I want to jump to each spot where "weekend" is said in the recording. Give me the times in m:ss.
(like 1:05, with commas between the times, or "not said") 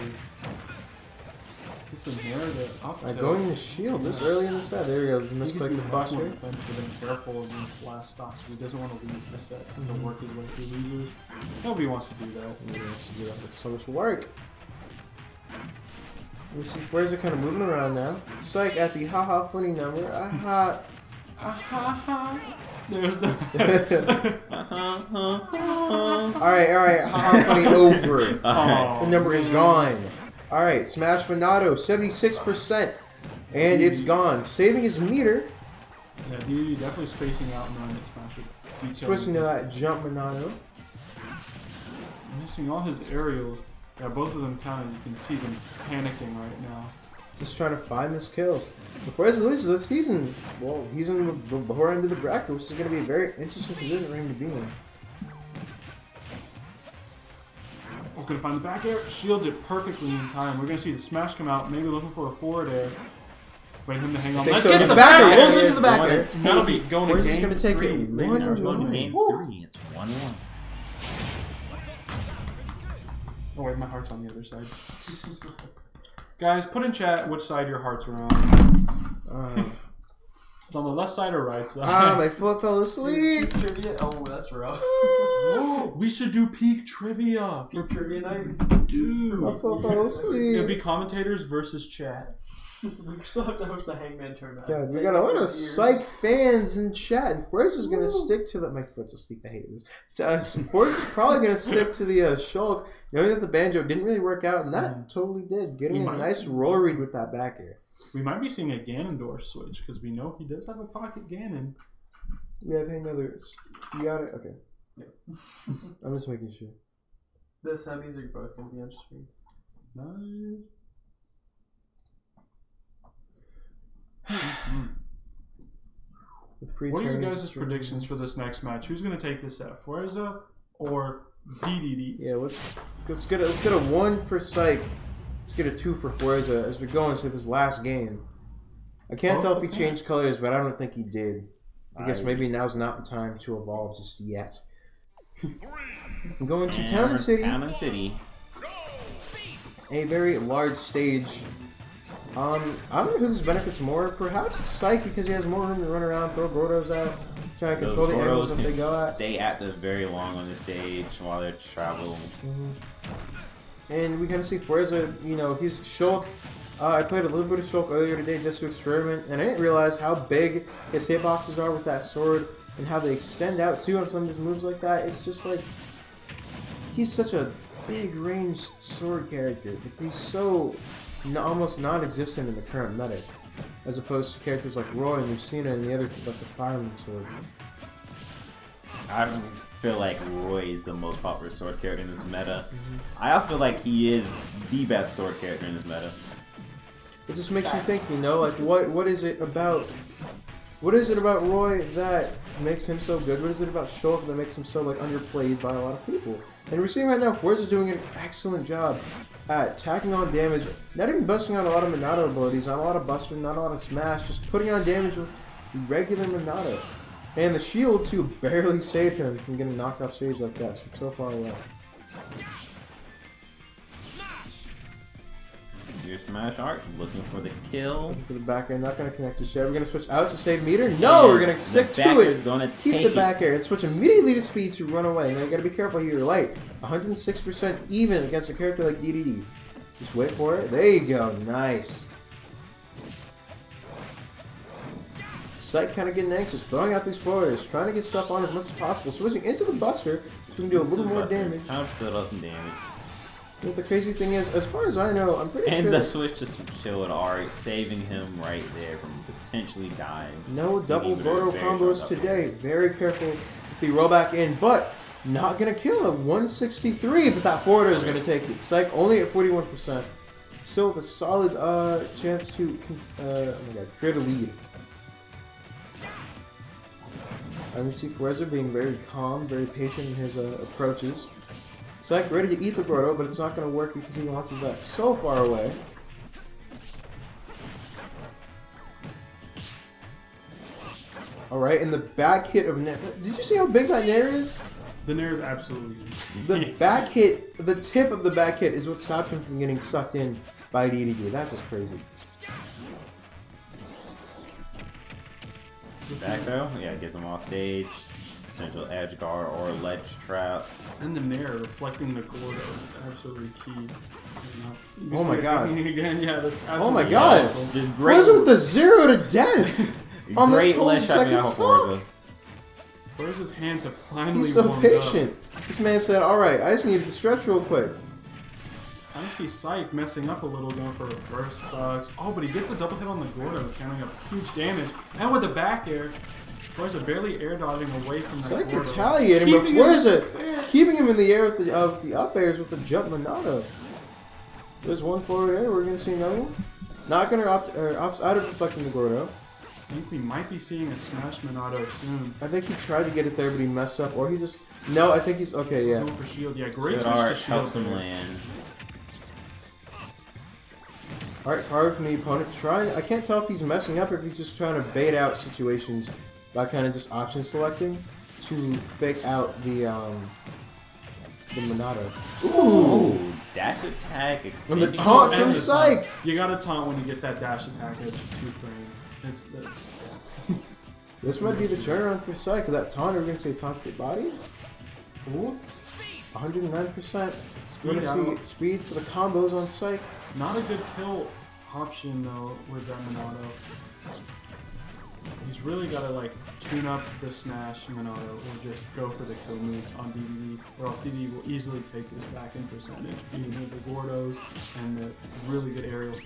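not said.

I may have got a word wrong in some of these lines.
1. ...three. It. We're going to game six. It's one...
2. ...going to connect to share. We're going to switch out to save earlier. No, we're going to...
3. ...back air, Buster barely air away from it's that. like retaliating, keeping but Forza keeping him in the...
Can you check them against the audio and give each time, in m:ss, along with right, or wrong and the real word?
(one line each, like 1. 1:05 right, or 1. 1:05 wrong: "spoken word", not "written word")
1. 1:07 wrong: "three", not "six"
2. 3:48 wrong: "meter", not "earlier"
3. 5:35 wrong: "Forza", not "Buster".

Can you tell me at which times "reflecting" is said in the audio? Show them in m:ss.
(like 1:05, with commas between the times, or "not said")
5:11.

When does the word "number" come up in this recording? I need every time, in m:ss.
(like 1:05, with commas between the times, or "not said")
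0:19, 0:29.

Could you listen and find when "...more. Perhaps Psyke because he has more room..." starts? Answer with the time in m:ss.
2:33.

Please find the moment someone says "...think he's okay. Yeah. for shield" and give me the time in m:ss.
5:55.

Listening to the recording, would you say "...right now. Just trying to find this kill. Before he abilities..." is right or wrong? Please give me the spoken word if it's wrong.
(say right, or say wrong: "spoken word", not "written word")
wrong: "loses", not "abilities".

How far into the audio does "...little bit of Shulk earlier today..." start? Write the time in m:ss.
2:47.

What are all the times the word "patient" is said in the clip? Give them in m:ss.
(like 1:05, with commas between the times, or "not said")
4:39, 5:24.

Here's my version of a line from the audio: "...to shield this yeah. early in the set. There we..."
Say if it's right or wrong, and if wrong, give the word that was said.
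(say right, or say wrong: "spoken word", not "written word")
right.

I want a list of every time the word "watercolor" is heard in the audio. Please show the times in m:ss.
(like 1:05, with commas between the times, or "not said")
not said.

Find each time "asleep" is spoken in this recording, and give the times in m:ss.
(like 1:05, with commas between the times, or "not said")
1:22, 1:30, 1:39.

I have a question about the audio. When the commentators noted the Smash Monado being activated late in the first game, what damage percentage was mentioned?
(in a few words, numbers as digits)
76%.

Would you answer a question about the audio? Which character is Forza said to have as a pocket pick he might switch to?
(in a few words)
Ganondorf.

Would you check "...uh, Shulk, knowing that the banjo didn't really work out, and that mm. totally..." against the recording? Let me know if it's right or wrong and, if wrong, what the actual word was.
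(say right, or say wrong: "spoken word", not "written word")
right.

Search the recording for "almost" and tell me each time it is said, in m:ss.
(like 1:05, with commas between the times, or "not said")
3:01.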